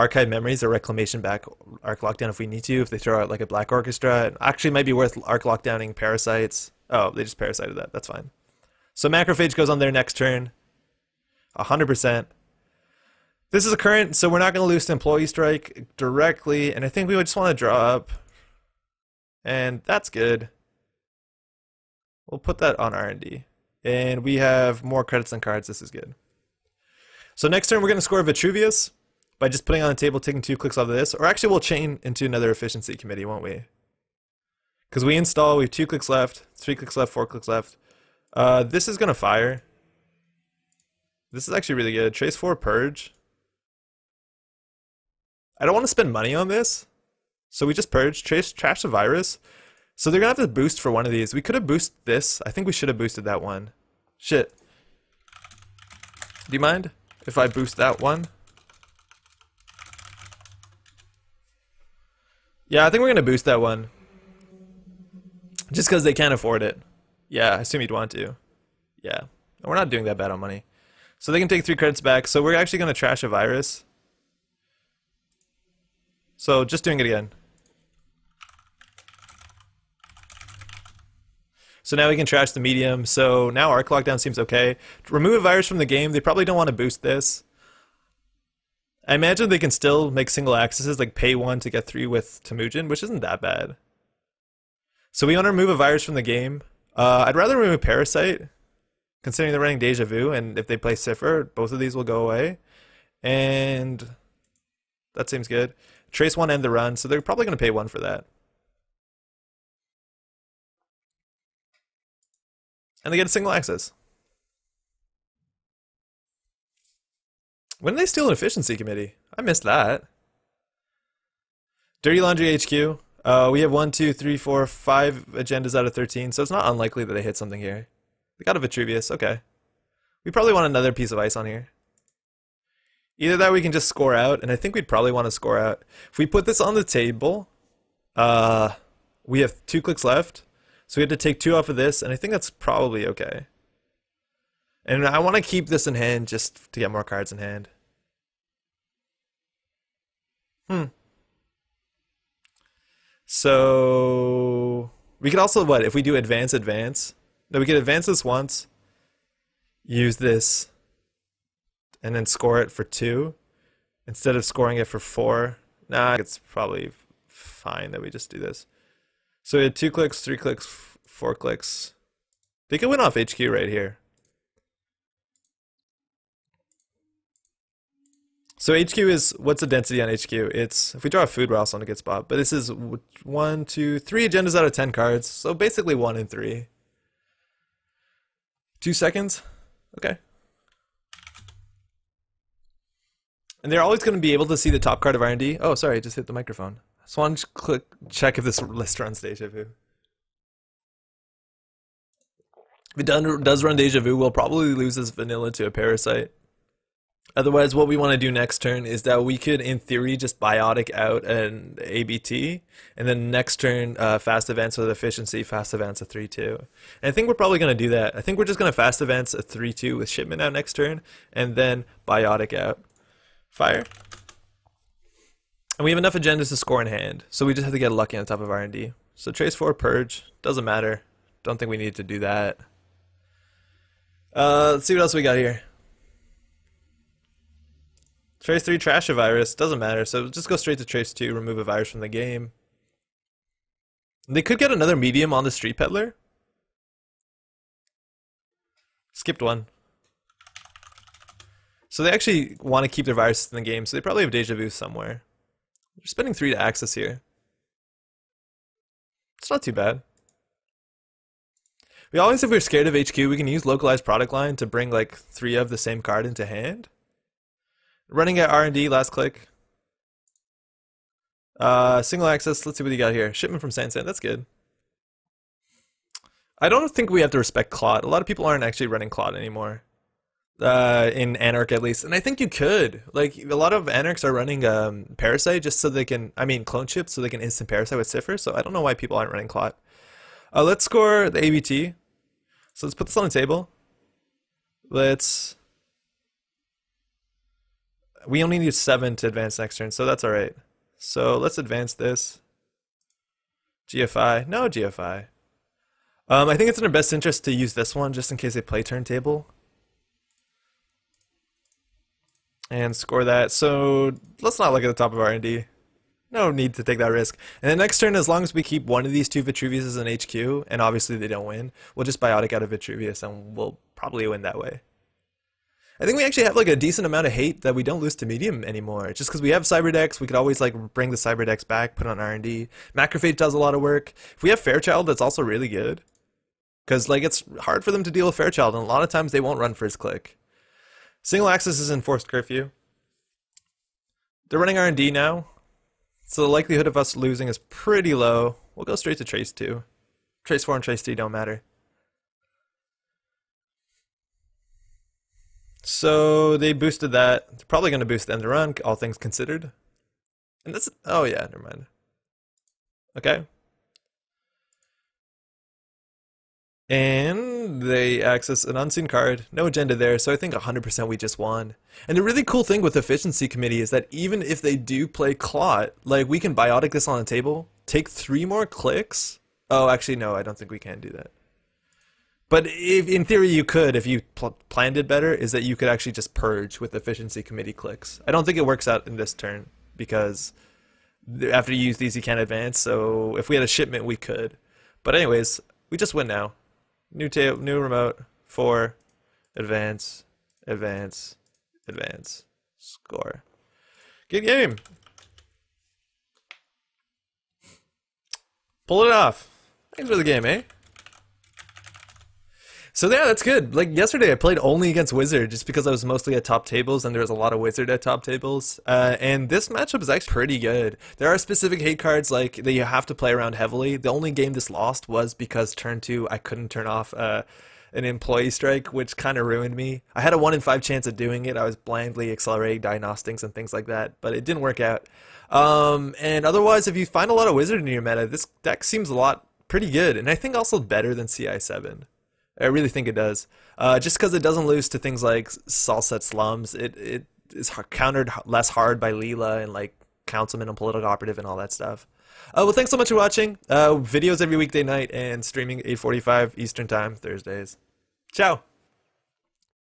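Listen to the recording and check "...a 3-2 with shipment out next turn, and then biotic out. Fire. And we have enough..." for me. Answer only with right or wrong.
right.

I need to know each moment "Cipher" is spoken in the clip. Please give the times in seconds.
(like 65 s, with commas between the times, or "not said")
100 s, 288 s.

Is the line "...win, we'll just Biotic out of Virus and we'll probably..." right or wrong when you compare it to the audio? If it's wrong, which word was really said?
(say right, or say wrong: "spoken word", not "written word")
wrong: "Vitruvius", not "Virus".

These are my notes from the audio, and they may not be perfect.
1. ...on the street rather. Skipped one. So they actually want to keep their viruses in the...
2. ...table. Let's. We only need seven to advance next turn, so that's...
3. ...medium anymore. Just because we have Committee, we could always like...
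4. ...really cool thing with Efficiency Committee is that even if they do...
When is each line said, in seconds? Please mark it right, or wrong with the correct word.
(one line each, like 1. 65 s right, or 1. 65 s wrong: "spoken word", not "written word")
1. 245 s wrong: "peddler", not "rather"
2. 293 s right
3. 328 s wrong: "Cyberdex", not "Committee"
4. 372 s right.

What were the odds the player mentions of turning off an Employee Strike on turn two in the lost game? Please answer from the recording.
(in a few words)
1 in 5.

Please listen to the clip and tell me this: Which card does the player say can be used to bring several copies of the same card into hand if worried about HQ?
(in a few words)
Localized Product Line.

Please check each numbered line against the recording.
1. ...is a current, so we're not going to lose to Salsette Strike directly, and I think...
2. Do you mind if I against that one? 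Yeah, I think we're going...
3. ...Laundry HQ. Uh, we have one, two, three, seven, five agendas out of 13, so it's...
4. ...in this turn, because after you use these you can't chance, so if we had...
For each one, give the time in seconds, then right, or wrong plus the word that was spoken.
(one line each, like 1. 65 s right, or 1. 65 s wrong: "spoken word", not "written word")
1. 13 s wrong: "Employee", not "Salsette"
2. 56 s wrong: "boost", not "against"
3. 122 s wrong: "four", not "seven"
4. 389 s wrong: "advance", not "chance".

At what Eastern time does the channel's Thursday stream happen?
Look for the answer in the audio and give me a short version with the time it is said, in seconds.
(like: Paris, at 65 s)
8:45, at 455 s.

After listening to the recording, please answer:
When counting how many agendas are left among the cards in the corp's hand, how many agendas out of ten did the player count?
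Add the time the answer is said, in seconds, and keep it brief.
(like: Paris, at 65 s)
3, at 183 s.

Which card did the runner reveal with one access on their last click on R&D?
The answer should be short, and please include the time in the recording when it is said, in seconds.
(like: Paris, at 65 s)
Shipment from Sansan, at 273 s.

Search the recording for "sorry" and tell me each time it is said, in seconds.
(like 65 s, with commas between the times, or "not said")
195 s.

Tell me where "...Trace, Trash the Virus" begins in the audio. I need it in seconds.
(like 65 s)
48 s.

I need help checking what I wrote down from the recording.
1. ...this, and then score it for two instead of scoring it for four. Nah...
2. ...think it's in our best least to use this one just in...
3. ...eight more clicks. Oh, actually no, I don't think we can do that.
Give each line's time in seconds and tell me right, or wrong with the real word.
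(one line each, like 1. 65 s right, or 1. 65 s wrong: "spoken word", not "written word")
1. 160 s right
2. 306 s wrong: "interest", not "least"
3. 378 s wrong: "three", not "eight".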